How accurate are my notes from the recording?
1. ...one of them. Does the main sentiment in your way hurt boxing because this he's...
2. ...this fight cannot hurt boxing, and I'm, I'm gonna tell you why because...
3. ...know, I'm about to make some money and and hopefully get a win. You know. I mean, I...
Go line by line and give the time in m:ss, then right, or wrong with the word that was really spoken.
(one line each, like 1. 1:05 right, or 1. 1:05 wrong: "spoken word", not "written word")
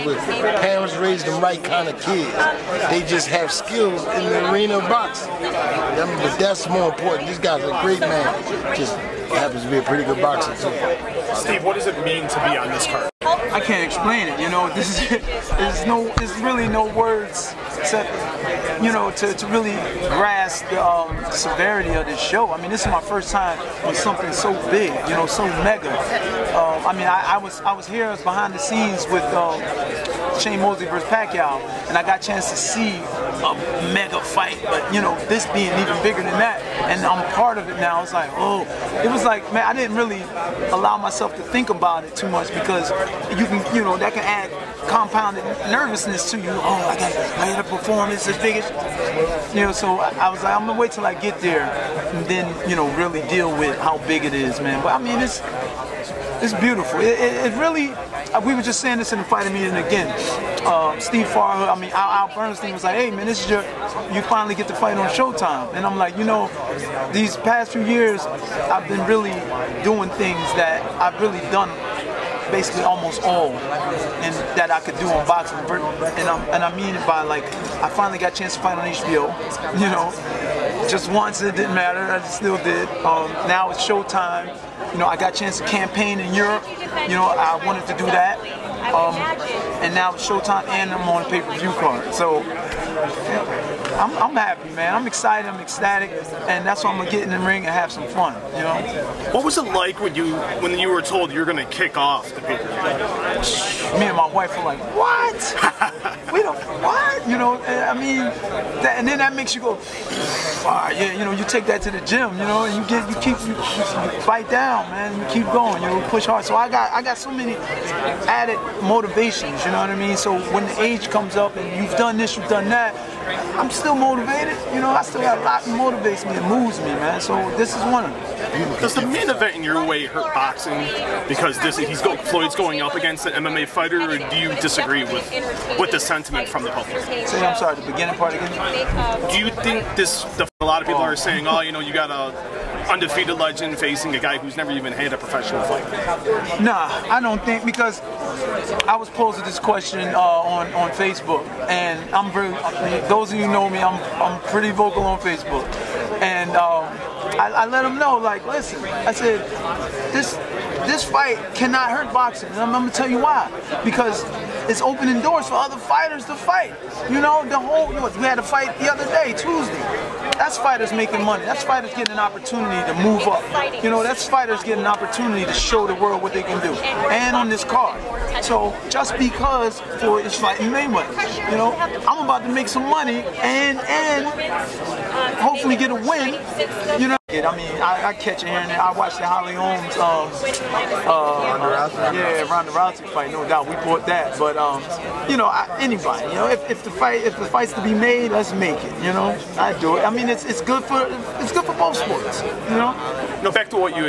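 1. 2:07 wrong: "event", not "sentiment"
2. 2:40 right
3. 3:01 right.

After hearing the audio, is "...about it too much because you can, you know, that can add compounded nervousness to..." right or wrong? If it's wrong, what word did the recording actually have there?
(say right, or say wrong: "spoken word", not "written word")
right.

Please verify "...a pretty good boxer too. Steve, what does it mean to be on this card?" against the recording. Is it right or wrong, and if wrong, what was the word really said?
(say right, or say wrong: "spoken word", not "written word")
right.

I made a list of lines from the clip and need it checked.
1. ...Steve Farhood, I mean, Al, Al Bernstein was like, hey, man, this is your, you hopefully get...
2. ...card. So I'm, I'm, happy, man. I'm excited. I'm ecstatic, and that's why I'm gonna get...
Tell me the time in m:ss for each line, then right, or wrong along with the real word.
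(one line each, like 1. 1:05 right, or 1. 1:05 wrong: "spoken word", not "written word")
1. 1:00 wrong: "finally", not "hopefully"
2. 1:31 right.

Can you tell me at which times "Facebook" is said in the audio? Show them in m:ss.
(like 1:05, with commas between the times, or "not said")
2:30, 2:35.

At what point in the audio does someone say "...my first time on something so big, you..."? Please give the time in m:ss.
0:22.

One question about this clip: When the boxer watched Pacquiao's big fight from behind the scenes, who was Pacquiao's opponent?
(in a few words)
Shane Mosley.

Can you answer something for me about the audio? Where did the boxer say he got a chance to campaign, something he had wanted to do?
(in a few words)
Europe.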